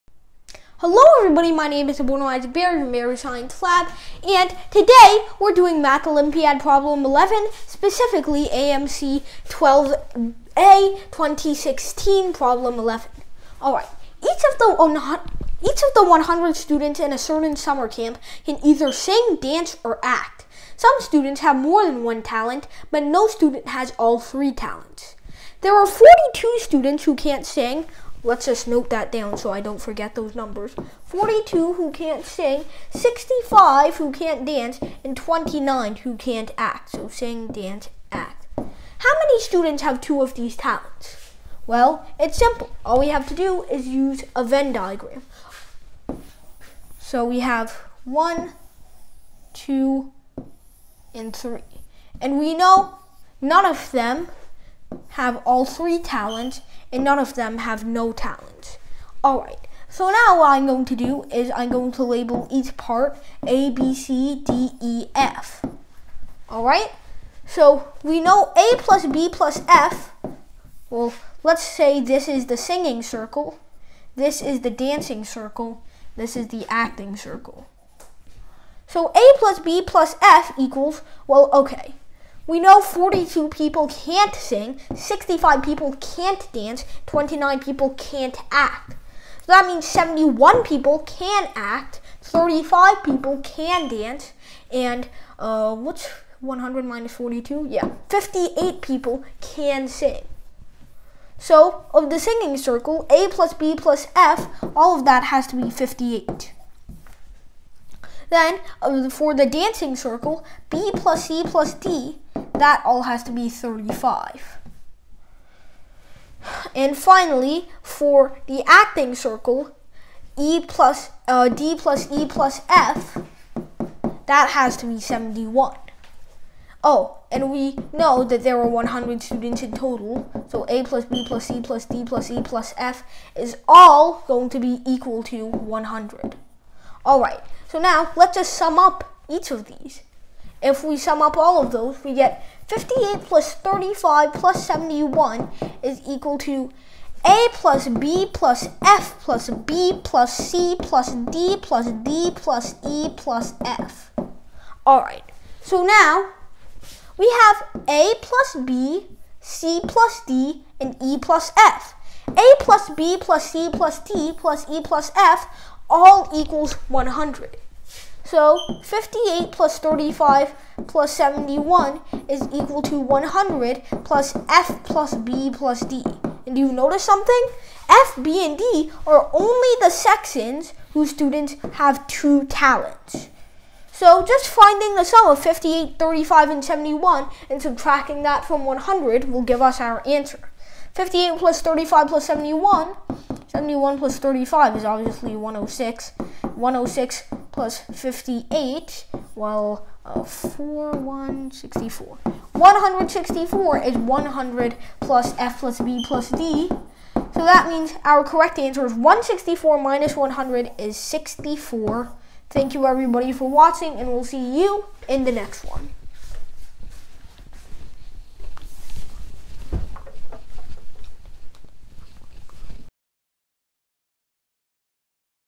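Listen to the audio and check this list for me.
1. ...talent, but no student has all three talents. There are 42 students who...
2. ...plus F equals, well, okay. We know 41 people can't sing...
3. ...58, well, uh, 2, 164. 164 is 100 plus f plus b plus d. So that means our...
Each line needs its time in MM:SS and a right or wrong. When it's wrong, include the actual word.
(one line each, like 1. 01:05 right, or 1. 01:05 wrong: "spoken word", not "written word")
1. 00:22 right
2. 01:19 wrong: "42", not "41"
3. 03:17 wrong: "4", not "2".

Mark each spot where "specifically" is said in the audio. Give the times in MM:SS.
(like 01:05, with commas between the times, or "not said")
00:07.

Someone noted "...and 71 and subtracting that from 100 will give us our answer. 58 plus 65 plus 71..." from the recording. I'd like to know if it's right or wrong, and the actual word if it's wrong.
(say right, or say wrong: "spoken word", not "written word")
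wrong: "35", not "65".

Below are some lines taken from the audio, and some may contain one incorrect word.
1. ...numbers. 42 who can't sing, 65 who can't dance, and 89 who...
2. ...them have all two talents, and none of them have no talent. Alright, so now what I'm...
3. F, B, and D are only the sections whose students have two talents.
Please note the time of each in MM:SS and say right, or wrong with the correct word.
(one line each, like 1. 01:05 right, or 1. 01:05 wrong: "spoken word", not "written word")
1. 00:30 wrong: "29", not "89"
2. 00:53 wrong: "three", not "two"
3. 02:57 right.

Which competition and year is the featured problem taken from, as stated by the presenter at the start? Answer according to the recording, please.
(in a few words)
AMC 12A 2016.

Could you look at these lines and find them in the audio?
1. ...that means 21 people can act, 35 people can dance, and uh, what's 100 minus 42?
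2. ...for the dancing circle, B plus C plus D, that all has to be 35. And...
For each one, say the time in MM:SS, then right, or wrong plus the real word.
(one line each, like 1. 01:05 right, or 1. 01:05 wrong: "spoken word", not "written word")
1. 01:29 wrong: "71", not "21"
2. 01:49 right.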